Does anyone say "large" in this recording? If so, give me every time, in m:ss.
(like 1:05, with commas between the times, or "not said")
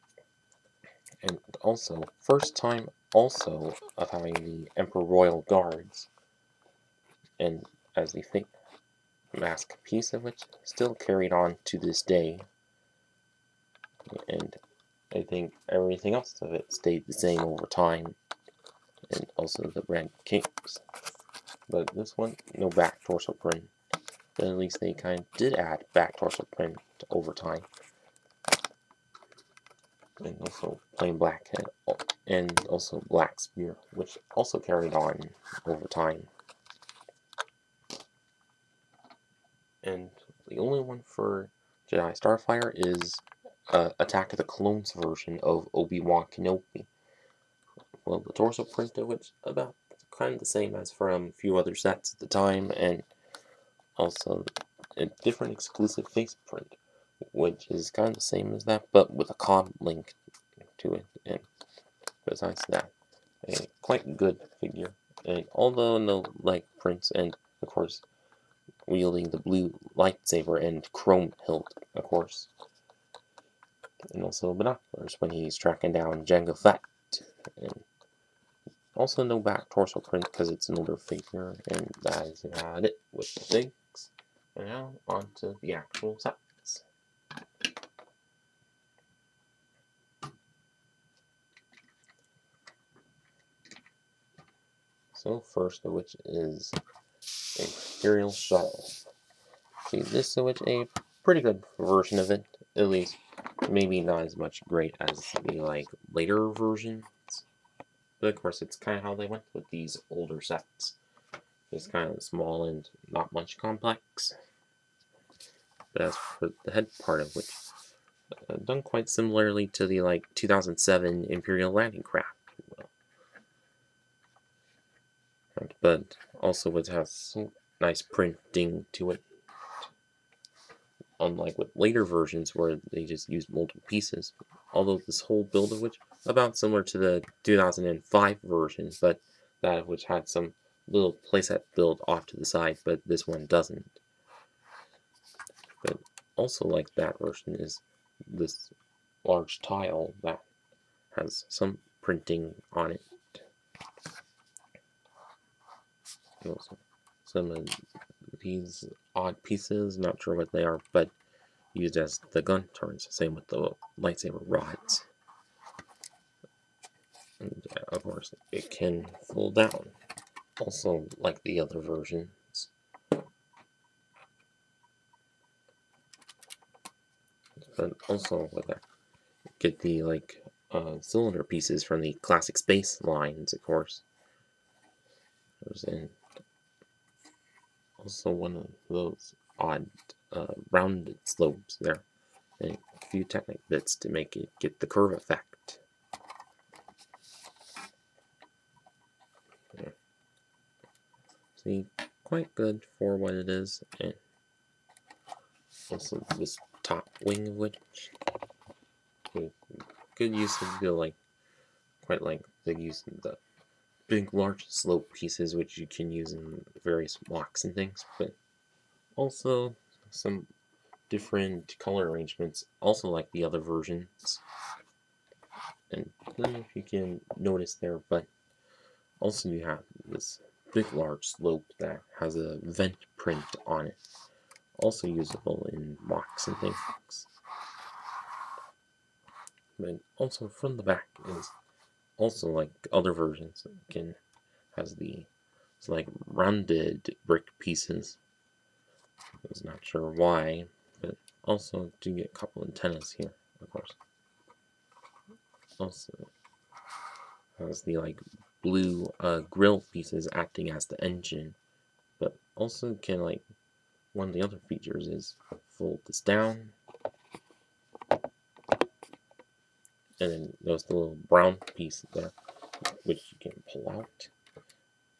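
2:29, 3:34, 3:50.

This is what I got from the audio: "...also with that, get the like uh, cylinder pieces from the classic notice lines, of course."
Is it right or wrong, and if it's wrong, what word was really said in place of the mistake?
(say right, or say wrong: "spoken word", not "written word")
wrong: "space", not "notice".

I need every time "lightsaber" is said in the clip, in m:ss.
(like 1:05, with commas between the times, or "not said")
1:09, 2:43.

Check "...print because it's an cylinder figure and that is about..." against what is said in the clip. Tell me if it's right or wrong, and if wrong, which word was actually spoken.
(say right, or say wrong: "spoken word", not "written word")
wrong: "older", not "cylinder".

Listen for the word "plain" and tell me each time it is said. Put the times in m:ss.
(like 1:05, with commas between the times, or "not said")
0:30.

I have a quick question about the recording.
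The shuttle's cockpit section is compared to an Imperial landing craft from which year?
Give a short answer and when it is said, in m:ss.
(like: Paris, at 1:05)
2007, at 2:00.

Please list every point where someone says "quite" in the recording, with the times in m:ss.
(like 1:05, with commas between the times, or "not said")
1:03, 1:58, 3:22, 3:32.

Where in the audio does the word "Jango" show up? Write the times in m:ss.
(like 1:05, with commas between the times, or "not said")
1:16.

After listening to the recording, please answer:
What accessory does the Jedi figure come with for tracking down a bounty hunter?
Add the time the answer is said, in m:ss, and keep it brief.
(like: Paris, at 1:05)
Binoculars, at 1:14.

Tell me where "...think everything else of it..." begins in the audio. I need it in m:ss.
0:15.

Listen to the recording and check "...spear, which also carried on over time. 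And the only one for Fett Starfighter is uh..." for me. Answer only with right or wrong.
wrong.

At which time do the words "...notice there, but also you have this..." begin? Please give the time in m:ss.
3:47.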